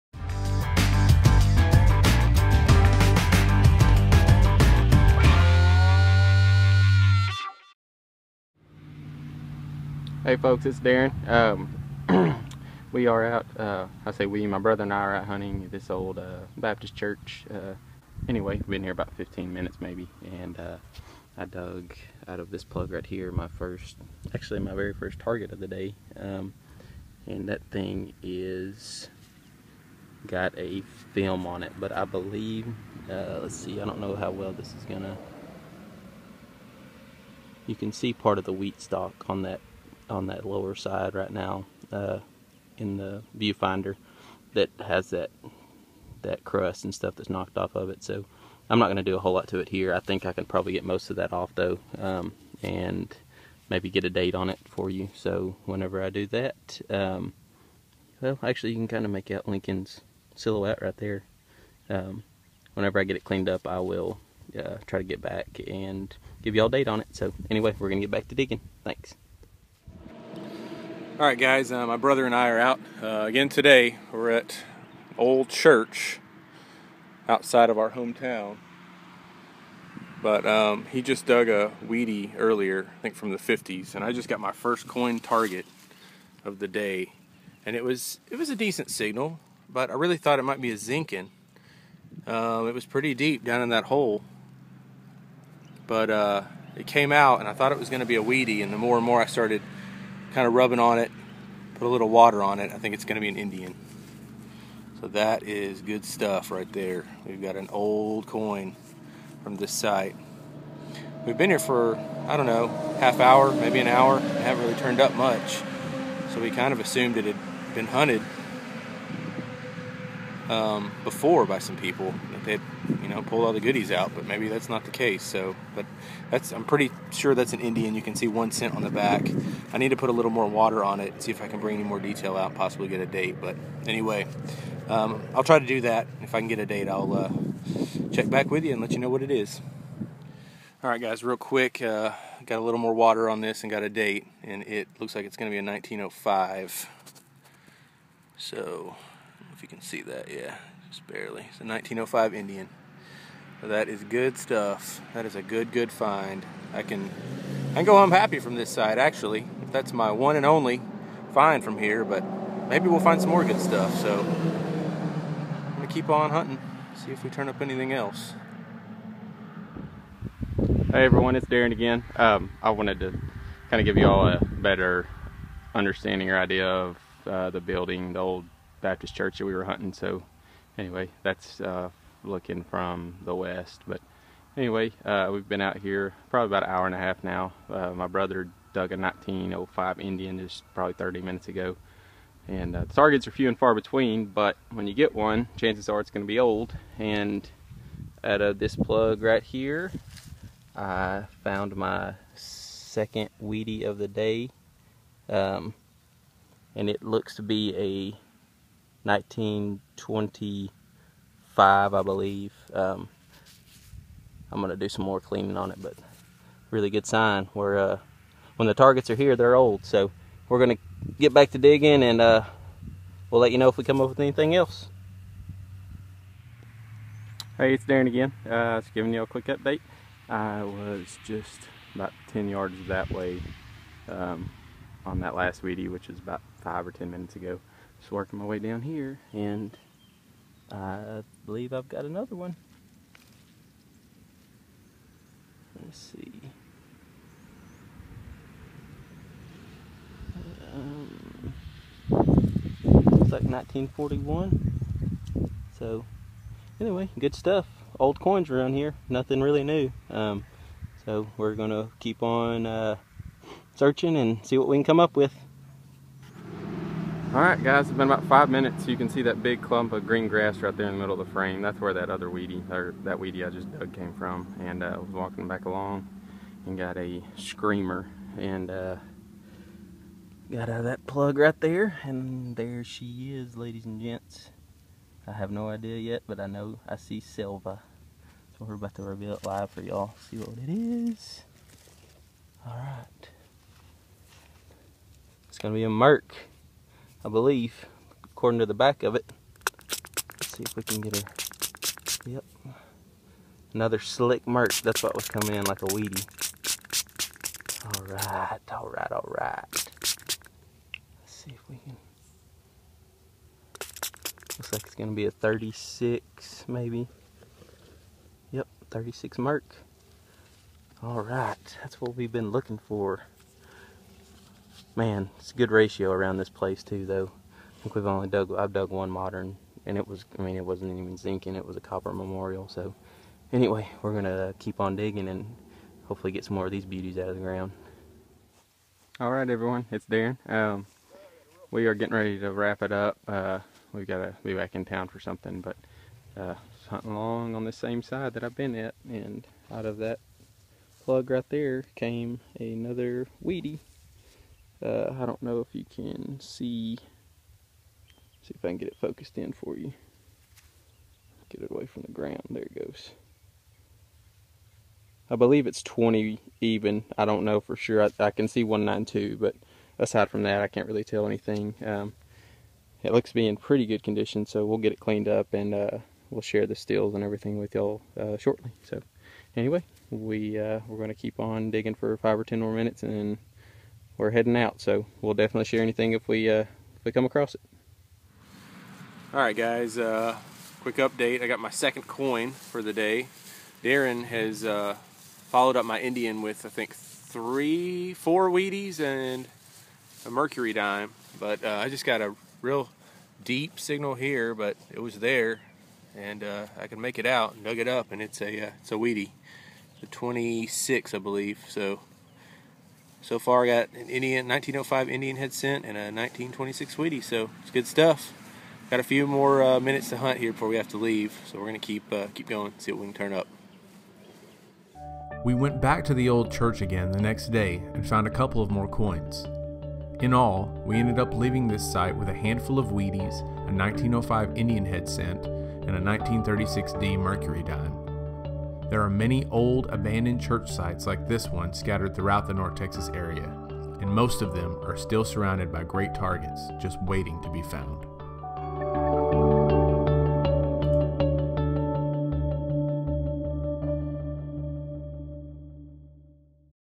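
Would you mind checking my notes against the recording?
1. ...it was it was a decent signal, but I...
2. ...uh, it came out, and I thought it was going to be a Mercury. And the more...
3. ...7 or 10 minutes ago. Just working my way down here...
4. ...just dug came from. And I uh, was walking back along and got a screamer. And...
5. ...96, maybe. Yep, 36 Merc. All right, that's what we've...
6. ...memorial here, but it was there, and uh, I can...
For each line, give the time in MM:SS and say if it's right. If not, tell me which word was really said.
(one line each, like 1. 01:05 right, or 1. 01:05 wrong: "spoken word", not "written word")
1. 01:27 right
2. 01:36 wrong: "Wheatie", not "Mercury"
3. 03:56 wrong: "5", not "7"
4. 04:33 right
5. 05:15 wrong: "36", not "96"
6. 06:43 wrong: "signal", not "memorial".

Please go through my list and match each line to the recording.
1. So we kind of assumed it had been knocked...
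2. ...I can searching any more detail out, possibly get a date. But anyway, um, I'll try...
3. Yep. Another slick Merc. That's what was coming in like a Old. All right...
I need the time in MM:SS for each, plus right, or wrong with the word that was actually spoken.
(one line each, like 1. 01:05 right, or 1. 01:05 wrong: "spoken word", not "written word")
1. 01:56 wrong: "hunted", not "knocked"
2. 02:11 wrong: "bring", not "searching"
3. 05:02 wrong: "Wheatie", not "Old".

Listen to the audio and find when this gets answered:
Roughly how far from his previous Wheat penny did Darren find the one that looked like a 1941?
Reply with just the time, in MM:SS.
03:52.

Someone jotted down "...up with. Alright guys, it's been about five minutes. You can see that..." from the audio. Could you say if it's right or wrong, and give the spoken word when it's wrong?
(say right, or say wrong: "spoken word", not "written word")
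right.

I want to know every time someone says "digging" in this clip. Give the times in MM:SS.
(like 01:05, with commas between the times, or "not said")
01:08, 03:41, 05:34, 06:21.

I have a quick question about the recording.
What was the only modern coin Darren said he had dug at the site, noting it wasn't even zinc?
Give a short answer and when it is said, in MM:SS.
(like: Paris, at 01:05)
copper memorial, at 05:31.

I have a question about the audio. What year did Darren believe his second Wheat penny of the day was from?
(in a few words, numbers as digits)
1925.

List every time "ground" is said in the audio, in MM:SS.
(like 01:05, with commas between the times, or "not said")
05:37, 06:02.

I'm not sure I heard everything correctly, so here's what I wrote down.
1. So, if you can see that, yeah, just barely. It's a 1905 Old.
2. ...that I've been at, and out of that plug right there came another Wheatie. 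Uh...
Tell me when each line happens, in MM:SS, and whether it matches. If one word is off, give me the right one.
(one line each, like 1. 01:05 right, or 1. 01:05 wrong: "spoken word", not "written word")
1. 02:28 wrong: "Indian", not "Old"
2. 05:48 right.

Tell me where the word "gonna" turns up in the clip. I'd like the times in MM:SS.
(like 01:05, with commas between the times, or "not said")
00:34, 05:14, 05:34, 07:01.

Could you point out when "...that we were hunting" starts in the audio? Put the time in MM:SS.
02:59.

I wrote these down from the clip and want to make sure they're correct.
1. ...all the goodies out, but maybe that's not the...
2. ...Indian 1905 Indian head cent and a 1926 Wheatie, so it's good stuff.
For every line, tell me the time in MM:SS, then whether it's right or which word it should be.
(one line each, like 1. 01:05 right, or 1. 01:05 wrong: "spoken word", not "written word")
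1. 02:03 right
2. 06:54 right.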